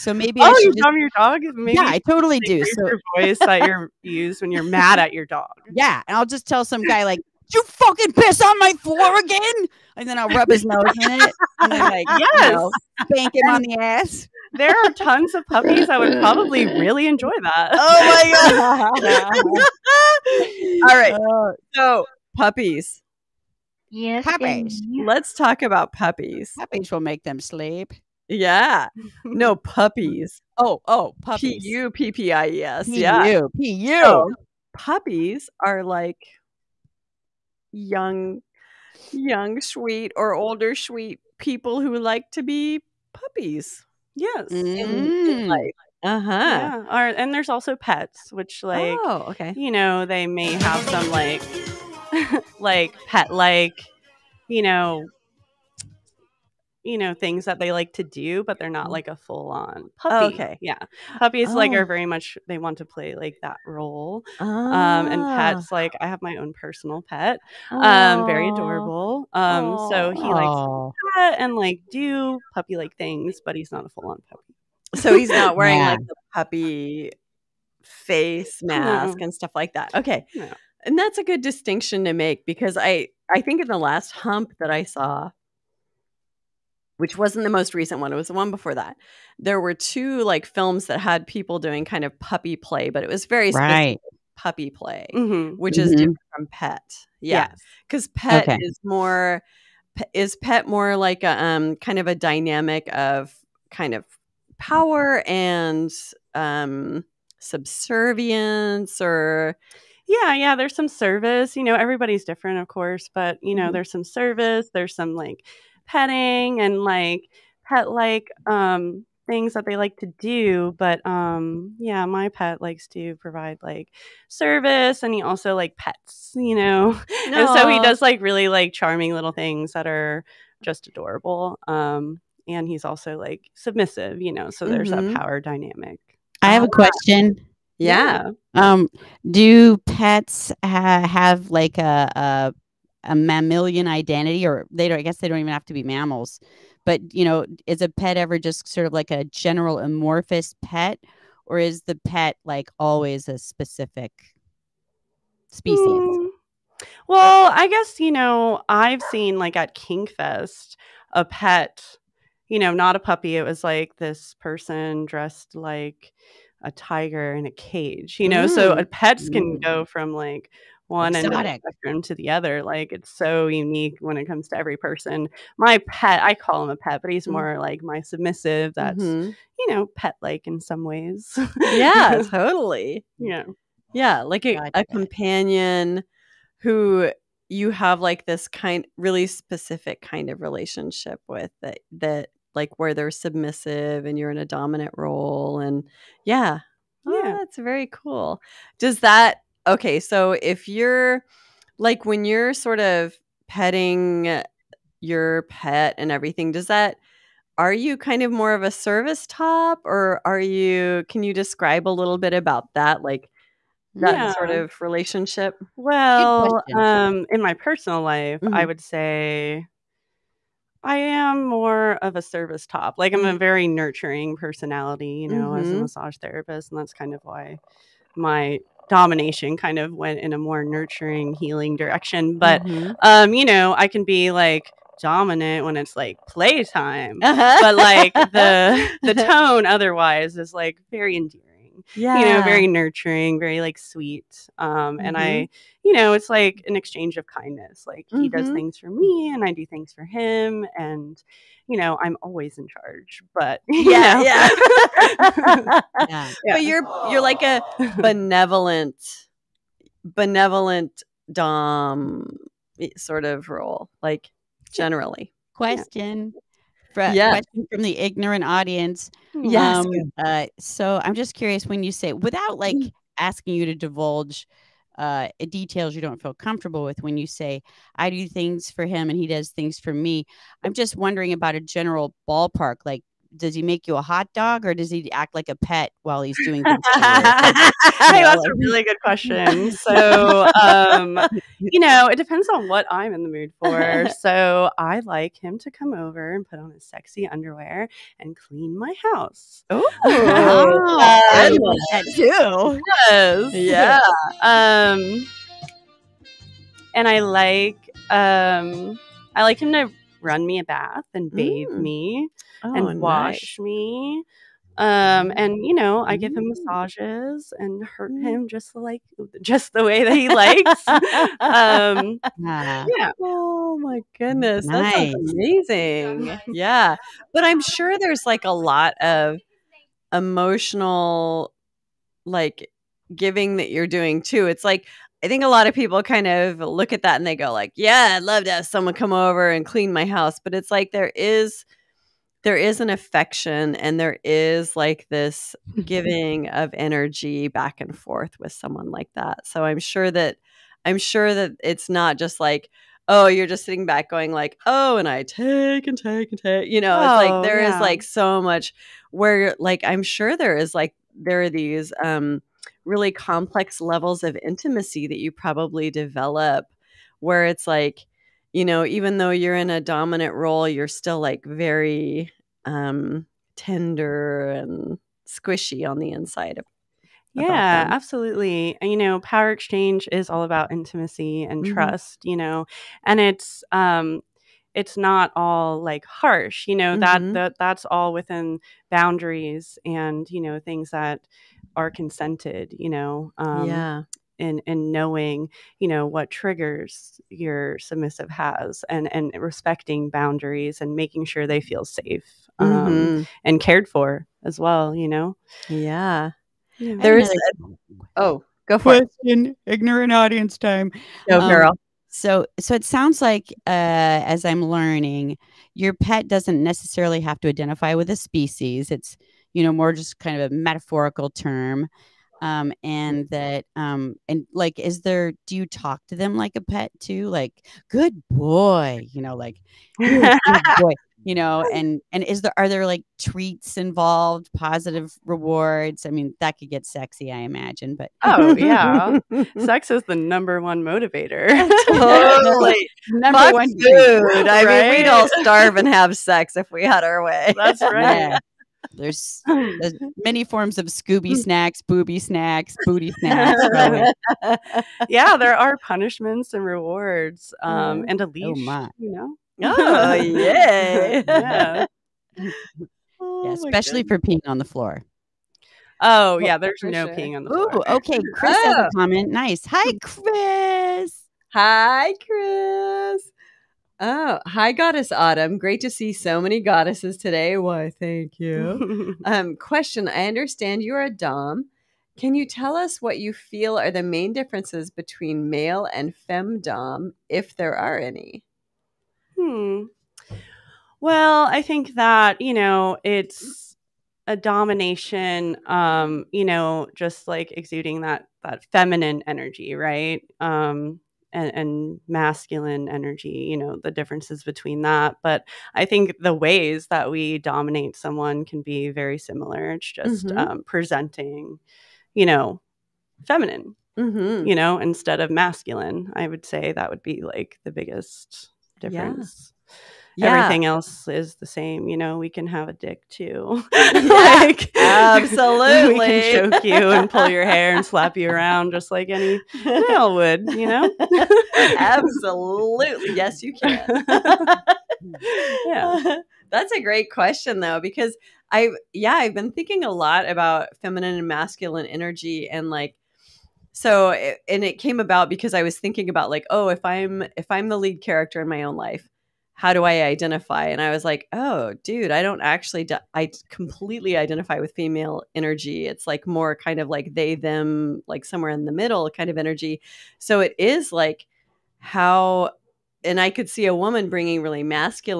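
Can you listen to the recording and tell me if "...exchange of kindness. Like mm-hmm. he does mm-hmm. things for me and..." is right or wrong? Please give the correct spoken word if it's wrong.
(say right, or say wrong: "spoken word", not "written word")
right.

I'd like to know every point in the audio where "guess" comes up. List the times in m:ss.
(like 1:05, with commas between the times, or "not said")
2:25, 2:37.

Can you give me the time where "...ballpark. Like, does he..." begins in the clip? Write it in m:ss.
4:42.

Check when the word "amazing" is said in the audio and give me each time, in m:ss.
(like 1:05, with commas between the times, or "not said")
5:25.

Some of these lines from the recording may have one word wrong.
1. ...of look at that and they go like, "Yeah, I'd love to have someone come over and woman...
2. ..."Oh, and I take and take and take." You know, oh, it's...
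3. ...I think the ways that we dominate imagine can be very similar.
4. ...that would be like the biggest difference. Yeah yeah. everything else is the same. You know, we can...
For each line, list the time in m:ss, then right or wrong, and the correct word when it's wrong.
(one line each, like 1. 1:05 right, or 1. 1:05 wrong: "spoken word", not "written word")
1. 5:36 wrong: "clean", not "woman"
2. 5:54 right
3. 8:25 wrong: "someone", not "imagine"
4. 8:36 right.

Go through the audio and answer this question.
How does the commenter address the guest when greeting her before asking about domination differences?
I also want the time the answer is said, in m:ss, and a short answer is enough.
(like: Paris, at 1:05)
Goddess Autumn, at 7:54.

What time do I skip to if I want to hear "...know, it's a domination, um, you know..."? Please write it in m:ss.
8:12.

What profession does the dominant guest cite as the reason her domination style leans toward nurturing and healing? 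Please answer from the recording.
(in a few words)
Massage therapist.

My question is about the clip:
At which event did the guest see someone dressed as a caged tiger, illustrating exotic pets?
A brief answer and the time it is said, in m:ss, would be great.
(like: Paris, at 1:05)
Kinkfest, at 2:39.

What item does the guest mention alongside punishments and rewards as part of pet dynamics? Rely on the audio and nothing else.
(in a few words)
Leash.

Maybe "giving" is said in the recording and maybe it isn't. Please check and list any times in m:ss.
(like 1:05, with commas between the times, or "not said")
5:33, 5:45.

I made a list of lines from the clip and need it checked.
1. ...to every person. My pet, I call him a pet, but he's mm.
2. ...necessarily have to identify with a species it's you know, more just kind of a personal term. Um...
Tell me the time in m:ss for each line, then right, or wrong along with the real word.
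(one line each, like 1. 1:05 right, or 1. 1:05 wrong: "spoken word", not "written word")
1. 2:54 right
2. 6:56 wrong: "metaphorical", not "personal".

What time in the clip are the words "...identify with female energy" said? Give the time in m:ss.
9:14.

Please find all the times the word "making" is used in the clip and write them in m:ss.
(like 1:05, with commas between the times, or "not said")
6:40.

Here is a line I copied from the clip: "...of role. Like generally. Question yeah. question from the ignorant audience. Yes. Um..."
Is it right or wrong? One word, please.
right.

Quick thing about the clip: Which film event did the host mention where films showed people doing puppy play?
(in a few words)
Hump.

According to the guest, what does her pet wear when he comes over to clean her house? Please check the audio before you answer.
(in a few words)
Sexy underwear.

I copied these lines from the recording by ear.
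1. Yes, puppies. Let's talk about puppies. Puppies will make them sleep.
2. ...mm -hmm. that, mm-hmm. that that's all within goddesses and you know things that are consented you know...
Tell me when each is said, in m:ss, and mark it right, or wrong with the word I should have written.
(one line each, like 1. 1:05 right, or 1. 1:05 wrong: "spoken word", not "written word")
1. 0:23 right
2. 6:26 wrong: "boundaries", not "goddesses".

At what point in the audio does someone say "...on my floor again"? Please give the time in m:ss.
0:08.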